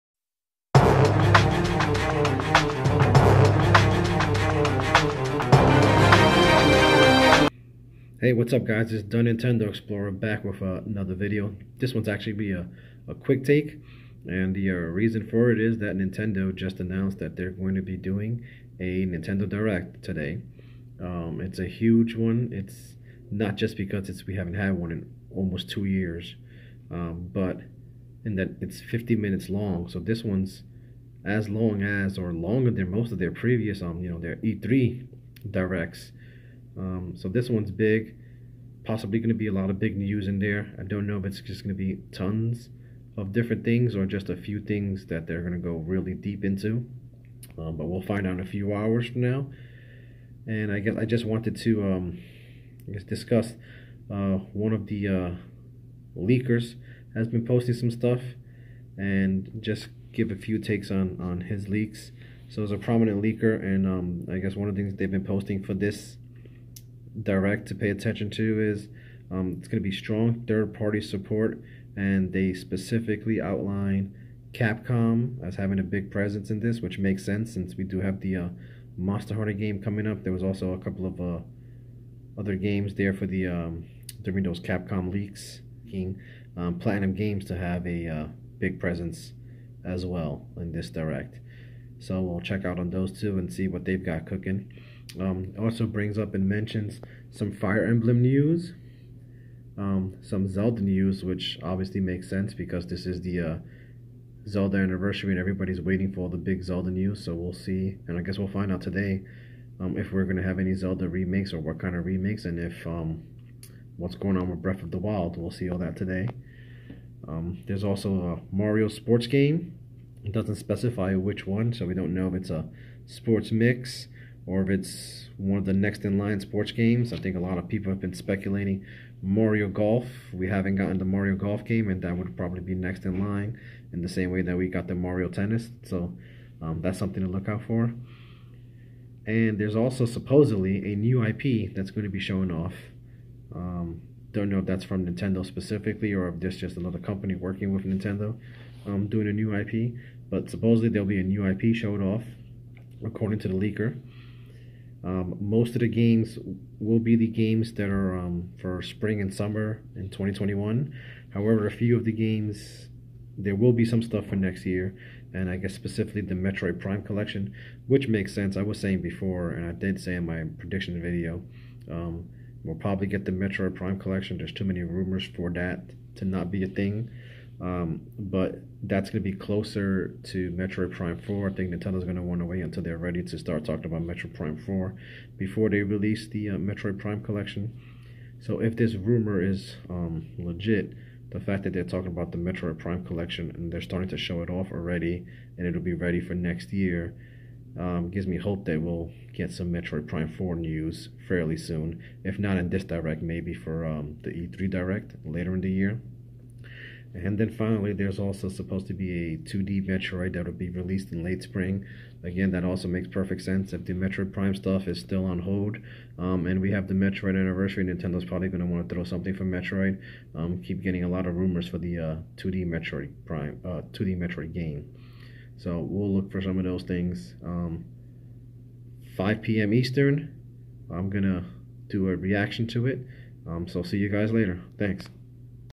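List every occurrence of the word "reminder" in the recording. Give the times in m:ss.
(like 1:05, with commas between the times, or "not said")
not said.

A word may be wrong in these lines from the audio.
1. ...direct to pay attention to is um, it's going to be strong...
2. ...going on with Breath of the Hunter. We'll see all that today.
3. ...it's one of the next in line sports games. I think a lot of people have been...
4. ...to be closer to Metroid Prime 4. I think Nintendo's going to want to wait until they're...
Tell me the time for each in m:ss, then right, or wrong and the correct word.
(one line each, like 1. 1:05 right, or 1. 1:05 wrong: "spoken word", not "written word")
1. 1:07 right
2. 1:54 wrong: "Wild", not "Hunter"
3. 2:04 right
4. 2:59 right.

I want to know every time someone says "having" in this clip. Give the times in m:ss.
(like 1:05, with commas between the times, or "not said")
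1:15.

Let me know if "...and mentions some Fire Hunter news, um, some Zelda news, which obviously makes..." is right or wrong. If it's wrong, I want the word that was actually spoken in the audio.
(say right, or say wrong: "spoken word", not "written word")
wrong: "Emblem", not "Hunter".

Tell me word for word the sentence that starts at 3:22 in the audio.
If not in this direct, maybe for um, the E3 direct later in the year.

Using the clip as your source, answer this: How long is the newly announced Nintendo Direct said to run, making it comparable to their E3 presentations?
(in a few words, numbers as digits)
50 minutes.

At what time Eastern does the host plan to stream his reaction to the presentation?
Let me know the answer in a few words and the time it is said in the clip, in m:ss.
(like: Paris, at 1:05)
5 p.m., at 3:49.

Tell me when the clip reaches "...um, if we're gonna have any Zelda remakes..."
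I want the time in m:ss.
1:49.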